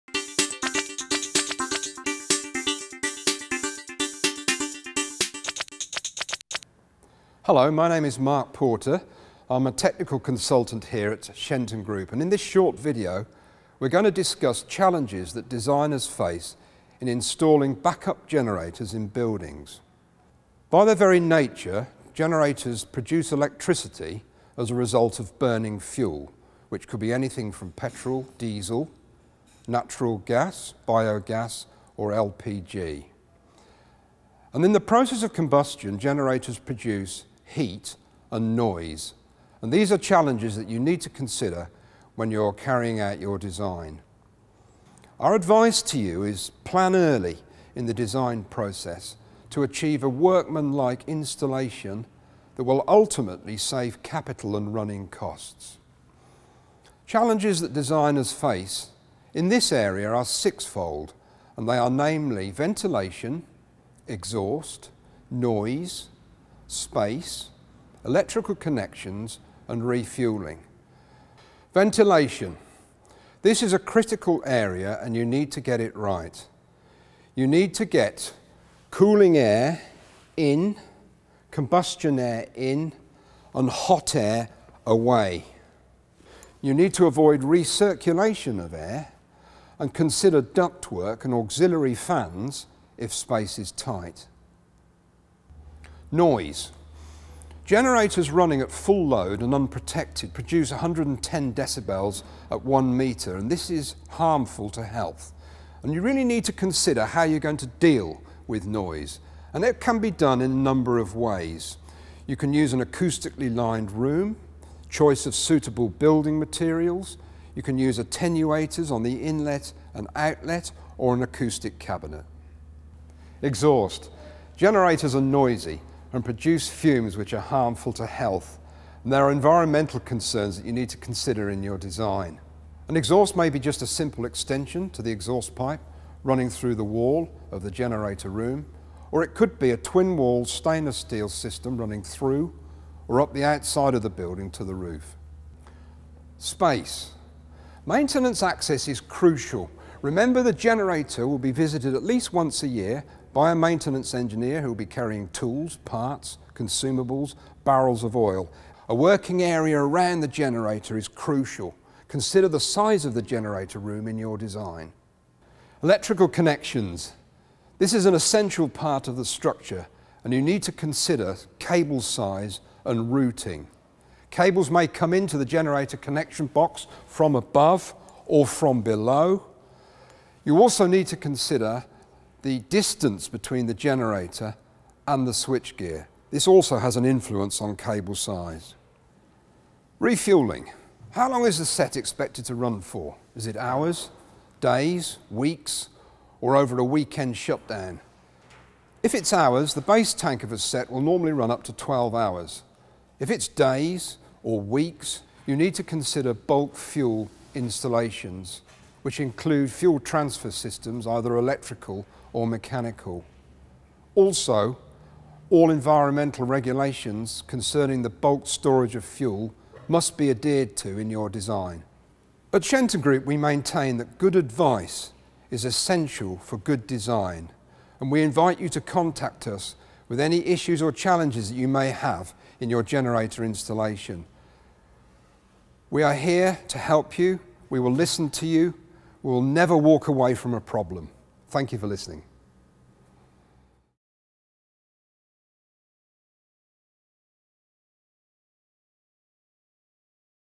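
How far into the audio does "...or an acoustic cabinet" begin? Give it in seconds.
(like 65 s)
120 s.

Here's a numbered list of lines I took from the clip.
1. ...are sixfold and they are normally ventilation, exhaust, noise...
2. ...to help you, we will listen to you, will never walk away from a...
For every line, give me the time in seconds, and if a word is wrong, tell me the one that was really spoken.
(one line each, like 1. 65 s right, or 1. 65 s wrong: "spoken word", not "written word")
1. 60 s wrong: "namely", not "normally"
2. 236 s right.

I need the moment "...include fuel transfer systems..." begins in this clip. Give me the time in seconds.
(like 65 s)
209 s.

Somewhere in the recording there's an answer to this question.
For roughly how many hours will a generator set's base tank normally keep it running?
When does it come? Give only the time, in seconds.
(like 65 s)
201 s.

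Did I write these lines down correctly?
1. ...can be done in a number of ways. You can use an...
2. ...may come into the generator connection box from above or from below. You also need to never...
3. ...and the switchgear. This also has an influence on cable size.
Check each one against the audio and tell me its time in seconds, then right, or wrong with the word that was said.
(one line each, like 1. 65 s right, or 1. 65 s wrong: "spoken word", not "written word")
1. 109 s right
2. 174 s wrong: "consider", not "never"
3. 185 s right.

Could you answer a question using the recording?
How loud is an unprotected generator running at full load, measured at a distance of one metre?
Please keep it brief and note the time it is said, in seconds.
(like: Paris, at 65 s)
110 decibels, at 100 s.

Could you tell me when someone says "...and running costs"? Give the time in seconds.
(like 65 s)
54 s.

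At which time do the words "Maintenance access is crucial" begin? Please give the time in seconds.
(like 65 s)
147 s.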